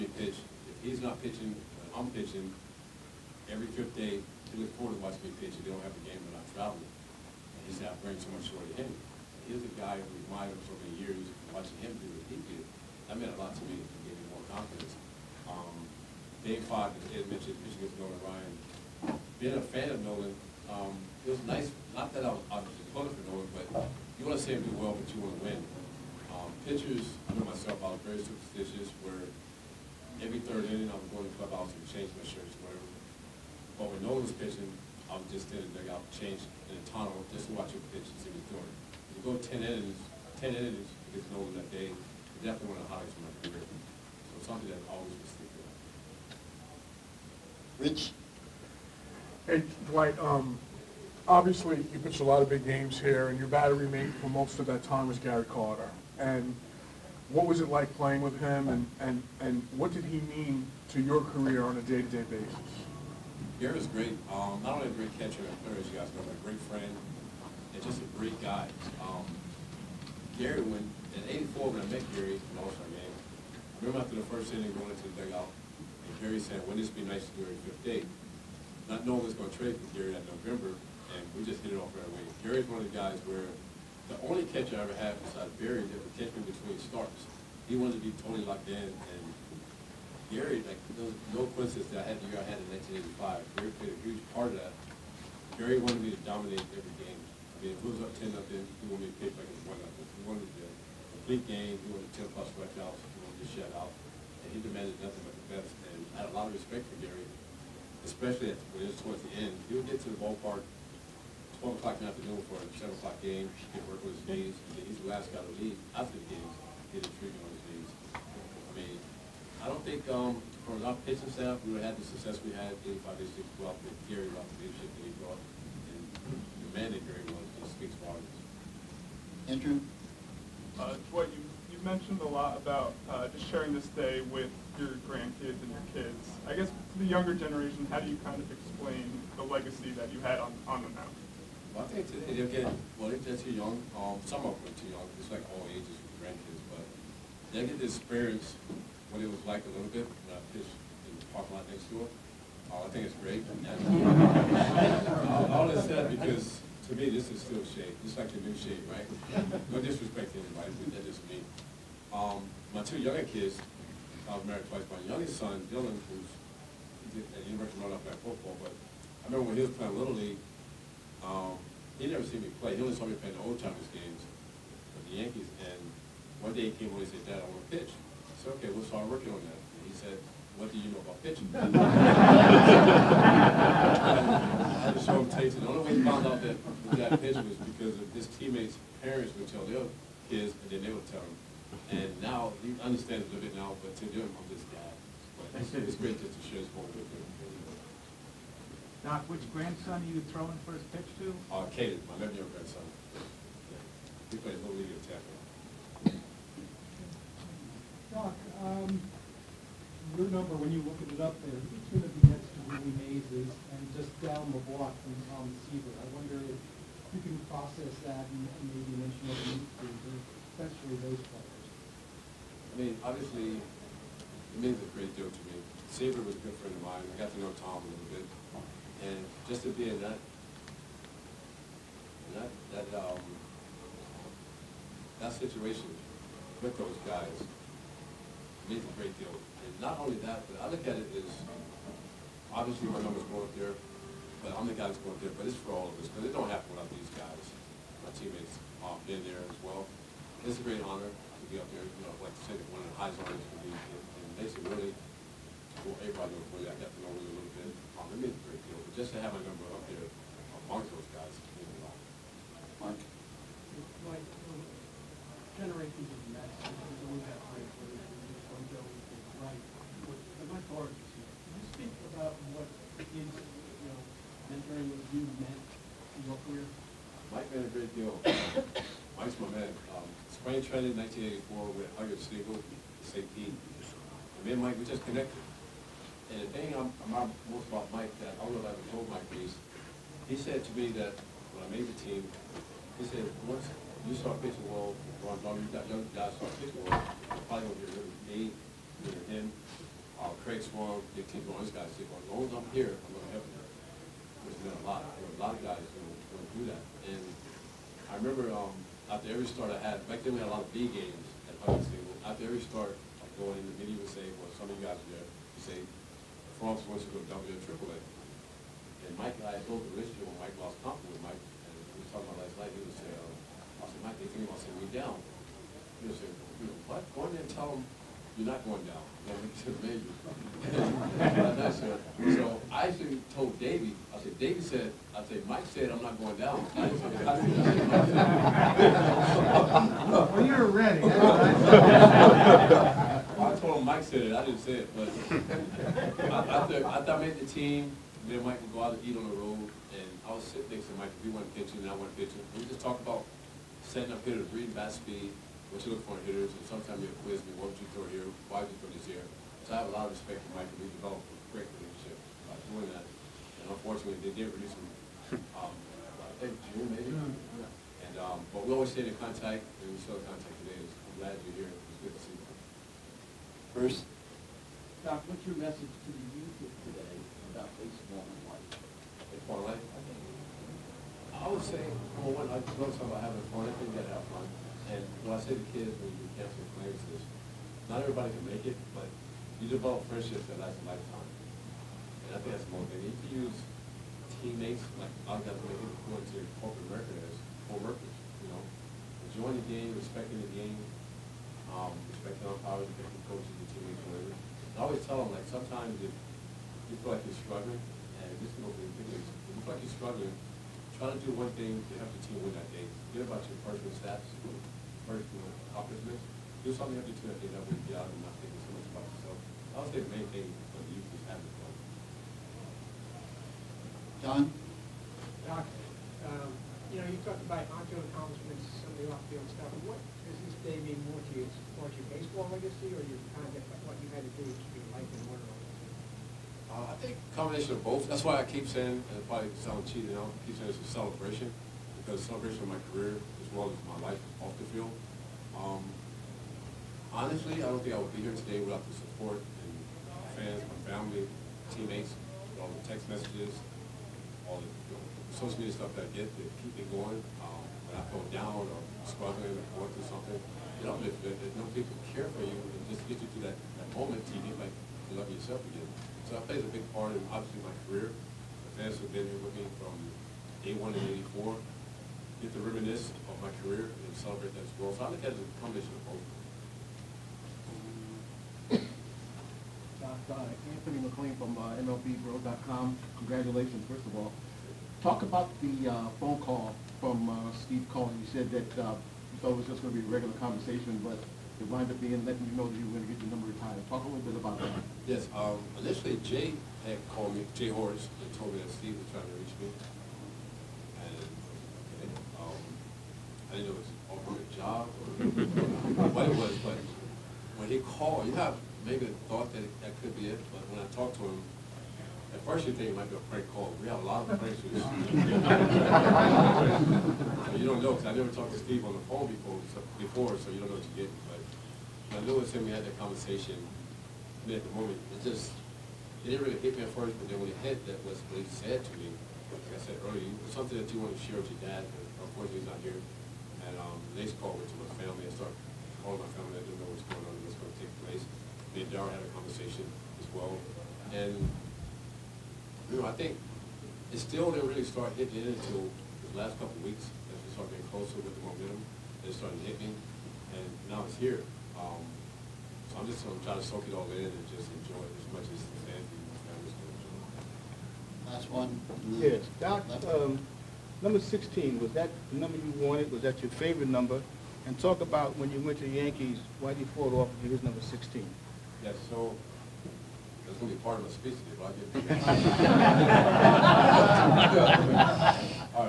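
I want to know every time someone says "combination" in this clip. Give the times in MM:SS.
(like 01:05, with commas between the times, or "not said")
07:17, 07:55.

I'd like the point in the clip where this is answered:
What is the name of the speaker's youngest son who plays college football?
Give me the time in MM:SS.
02:45.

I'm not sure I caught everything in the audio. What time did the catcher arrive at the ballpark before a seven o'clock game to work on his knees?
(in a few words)
4 o'clock.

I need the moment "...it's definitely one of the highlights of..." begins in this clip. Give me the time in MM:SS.
00:41.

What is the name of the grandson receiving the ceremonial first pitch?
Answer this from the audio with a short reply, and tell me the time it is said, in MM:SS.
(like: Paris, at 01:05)
Caden, at 03:21.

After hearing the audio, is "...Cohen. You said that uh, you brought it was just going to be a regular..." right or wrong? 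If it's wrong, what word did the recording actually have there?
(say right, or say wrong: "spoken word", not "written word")
wrong: "thought", not "brought".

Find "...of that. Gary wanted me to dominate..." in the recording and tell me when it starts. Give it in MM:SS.
01:34.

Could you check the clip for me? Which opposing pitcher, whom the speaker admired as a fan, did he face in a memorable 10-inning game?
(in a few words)
Nolan Ryan.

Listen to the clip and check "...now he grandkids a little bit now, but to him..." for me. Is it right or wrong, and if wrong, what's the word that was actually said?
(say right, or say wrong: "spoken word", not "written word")
wrong: "understands", not "grandkids".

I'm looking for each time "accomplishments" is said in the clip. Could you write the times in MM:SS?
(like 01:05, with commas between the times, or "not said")
06:55, 07:07.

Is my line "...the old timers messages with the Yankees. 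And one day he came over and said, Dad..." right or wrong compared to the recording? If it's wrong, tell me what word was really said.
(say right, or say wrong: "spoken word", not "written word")
wrong: "games", not "messages".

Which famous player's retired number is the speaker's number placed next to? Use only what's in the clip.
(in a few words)
Willie Mays.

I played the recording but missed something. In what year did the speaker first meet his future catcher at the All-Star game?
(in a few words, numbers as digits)
1984.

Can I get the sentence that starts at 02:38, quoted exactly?
It's like the new Shea, right?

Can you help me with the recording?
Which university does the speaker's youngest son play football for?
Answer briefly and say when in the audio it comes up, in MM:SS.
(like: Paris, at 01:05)
University of North Carolina, at 02:47.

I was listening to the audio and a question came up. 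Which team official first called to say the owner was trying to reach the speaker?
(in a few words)
Jay Horwitz.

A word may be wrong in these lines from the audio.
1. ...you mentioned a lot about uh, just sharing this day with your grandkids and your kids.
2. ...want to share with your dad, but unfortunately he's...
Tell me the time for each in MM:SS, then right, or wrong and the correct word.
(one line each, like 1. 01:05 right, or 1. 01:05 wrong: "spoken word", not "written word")
1. 02:11 right
2. 08:51 right.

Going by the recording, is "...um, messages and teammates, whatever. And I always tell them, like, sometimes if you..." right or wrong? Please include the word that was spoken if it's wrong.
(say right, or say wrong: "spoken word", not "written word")
wrong: "coaches", not "messages".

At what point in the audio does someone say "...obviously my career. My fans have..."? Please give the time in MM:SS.
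07:47.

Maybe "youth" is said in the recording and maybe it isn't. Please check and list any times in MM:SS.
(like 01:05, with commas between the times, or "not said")
06:16, 07:00.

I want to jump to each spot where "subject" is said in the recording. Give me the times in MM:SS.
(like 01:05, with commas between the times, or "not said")
not said.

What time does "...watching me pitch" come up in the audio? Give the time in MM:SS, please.
00:04.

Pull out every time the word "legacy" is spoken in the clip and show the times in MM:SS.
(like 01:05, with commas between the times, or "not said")
02:19, 07:12.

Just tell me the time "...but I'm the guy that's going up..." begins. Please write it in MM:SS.
04:04.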